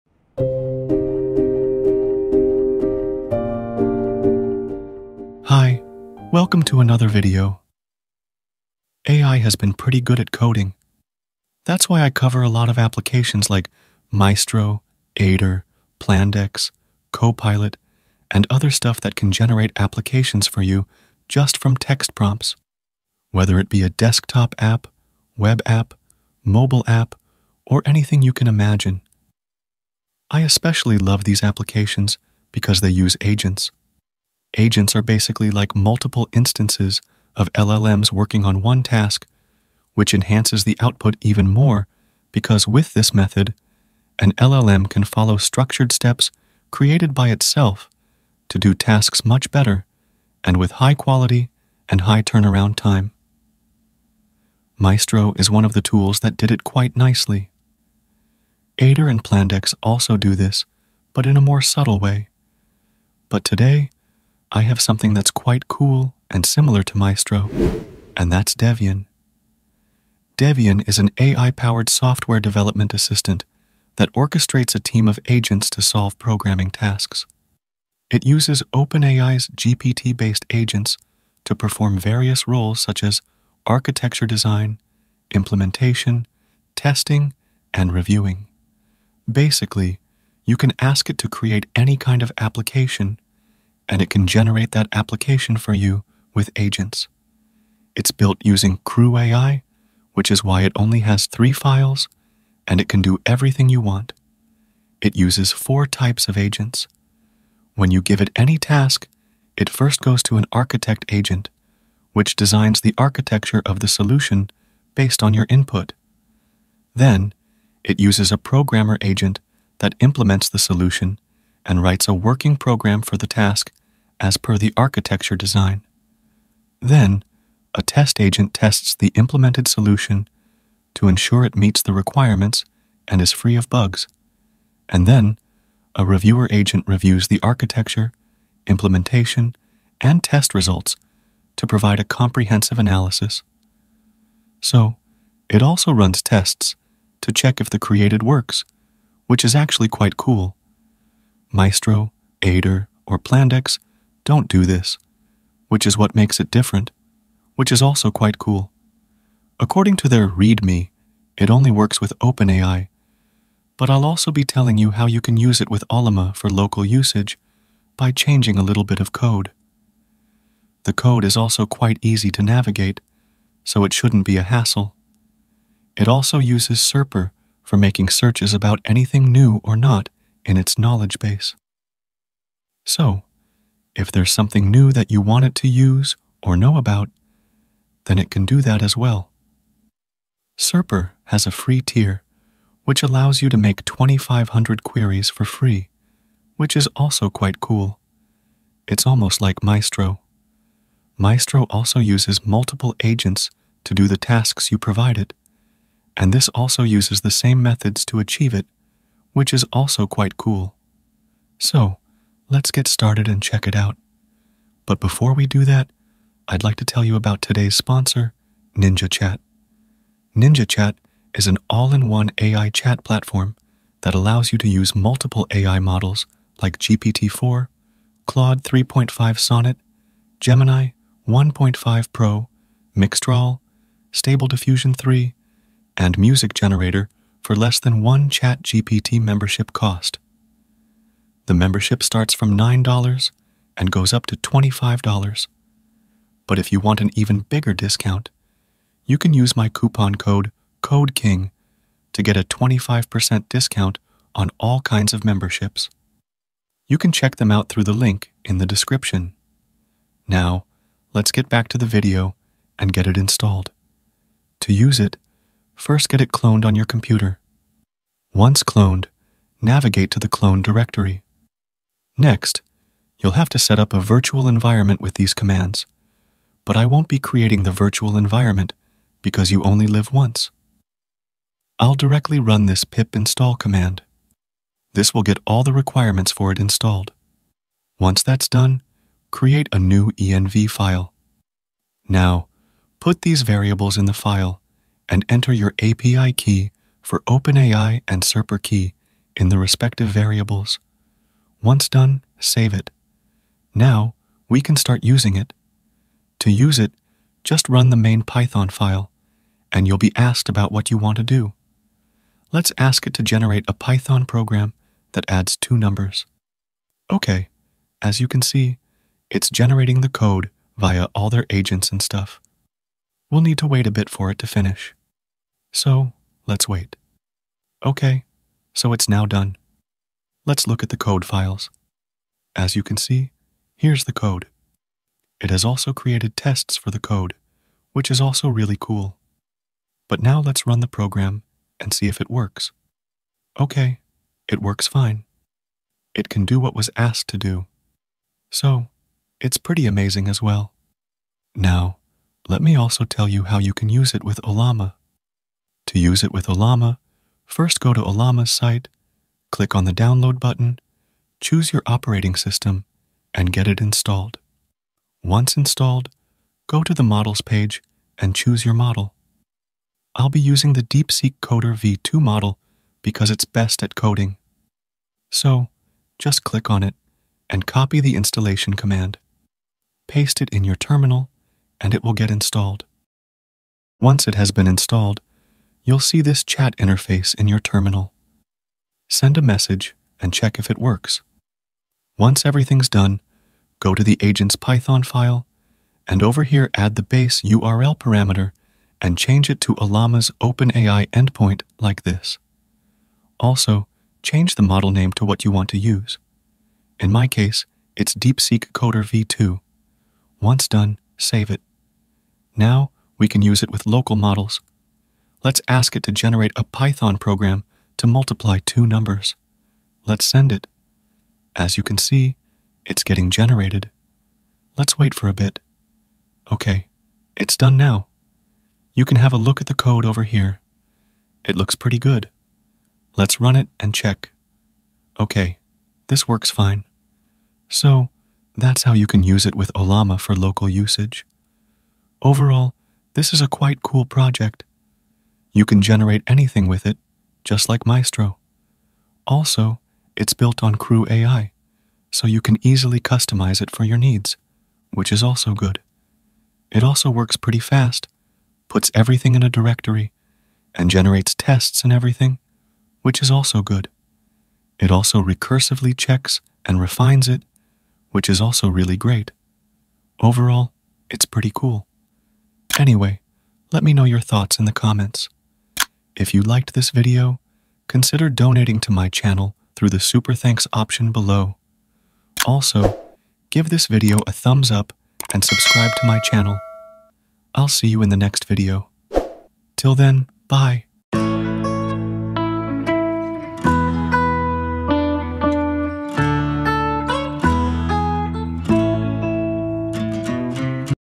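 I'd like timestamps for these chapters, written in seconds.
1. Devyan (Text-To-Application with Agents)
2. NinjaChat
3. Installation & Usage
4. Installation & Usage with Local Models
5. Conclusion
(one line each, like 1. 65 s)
1. 67 s
2. 216 s
3. 263 s
4. 357 s
5. 472 s.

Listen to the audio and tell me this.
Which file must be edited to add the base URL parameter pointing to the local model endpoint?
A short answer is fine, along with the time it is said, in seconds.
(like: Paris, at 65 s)
agent's Python file, at 394 s.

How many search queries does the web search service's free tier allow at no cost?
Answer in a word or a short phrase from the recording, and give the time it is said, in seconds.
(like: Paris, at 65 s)
2,500, at 193 s.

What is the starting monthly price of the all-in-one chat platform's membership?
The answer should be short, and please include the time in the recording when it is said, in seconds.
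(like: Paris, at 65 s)
$9, at 242 s.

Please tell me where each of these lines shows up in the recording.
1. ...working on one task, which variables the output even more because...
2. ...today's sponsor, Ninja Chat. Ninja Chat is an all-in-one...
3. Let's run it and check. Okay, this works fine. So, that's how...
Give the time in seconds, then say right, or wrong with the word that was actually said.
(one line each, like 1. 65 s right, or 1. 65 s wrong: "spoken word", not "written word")
1. 38 s wrong: "enhances", not "variables"
2. 217 s right
3. 433 s right.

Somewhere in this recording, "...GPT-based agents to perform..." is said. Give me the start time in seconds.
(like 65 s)
79 s.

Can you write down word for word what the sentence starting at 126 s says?
Then, a test agent tests the implemented solution to ensure it meets the requirements and is free of bugs.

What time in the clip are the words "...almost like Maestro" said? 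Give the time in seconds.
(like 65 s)
199 s.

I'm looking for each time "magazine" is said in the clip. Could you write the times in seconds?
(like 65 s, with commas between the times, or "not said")
not said.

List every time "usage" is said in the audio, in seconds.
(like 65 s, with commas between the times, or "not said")
166 s, 440 s.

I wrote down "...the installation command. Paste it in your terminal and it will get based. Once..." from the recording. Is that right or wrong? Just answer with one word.
wrong.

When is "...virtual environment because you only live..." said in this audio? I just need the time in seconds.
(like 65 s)
277 s.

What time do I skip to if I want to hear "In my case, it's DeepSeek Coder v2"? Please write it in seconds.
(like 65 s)
406 s.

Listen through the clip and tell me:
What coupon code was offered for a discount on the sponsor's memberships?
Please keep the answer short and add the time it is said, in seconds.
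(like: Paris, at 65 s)
CODEKING, at 250 s.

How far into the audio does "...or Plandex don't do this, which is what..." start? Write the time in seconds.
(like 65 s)
153 s.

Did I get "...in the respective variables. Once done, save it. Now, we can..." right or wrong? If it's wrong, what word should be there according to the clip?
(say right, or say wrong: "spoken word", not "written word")
right.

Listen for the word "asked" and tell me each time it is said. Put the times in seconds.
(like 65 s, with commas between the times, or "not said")
310 s, 346 s.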